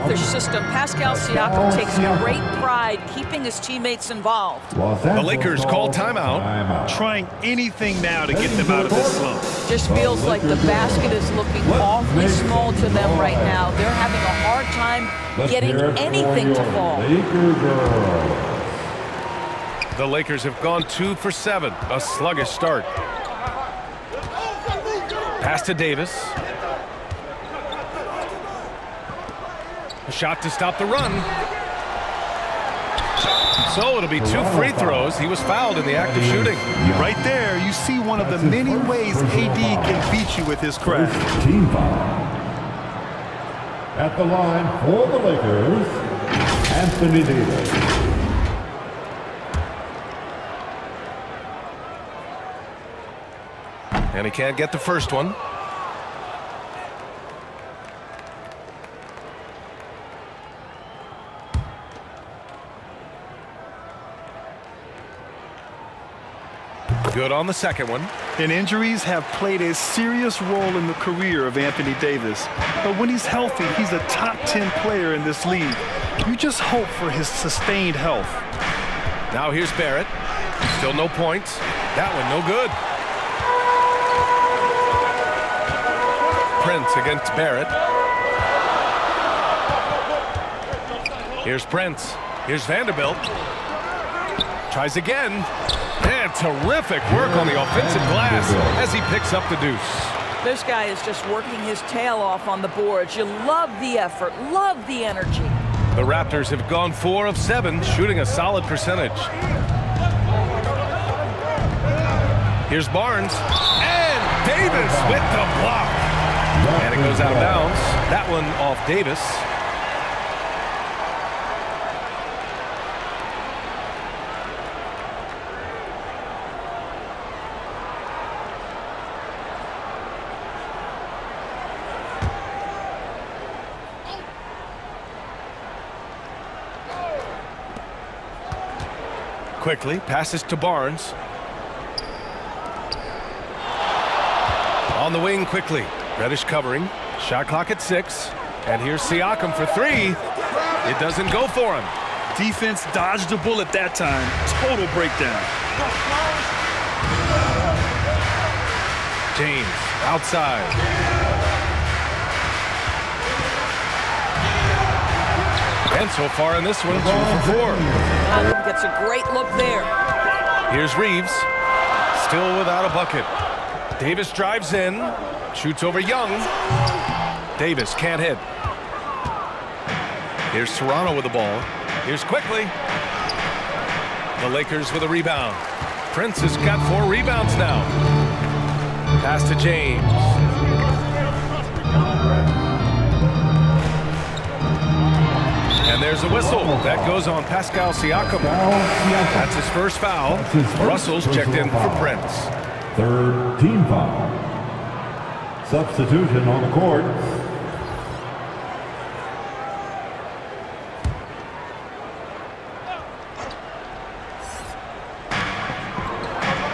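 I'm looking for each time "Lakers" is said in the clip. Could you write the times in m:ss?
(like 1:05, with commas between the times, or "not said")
0:05, 0:20, 0:45, 3:04.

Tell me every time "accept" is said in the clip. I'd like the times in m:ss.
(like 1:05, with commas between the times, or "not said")
not said.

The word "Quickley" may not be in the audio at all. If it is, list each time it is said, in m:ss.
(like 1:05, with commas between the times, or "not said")
2:19, 2:25, 3:02.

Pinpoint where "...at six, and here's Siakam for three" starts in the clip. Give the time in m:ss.
2:27.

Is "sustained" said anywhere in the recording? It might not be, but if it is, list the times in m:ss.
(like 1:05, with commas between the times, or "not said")
1:17.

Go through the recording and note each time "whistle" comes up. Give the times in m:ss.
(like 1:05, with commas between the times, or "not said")
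3:16.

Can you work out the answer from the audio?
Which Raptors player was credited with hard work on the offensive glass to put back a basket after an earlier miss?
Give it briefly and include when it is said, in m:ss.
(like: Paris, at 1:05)
Vanderbilt, at 1:32.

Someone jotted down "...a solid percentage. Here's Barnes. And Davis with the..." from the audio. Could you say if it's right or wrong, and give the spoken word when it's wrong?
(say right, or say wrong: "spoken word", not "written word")
right.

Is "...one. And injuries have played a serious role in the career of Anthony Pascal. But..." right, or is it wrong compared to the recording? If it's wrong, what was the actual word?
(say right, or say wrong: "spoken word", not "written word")
wrong: "Davis", not "Pascal".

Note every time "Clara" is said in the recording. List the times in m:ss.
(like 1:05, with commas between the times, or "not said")
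not said.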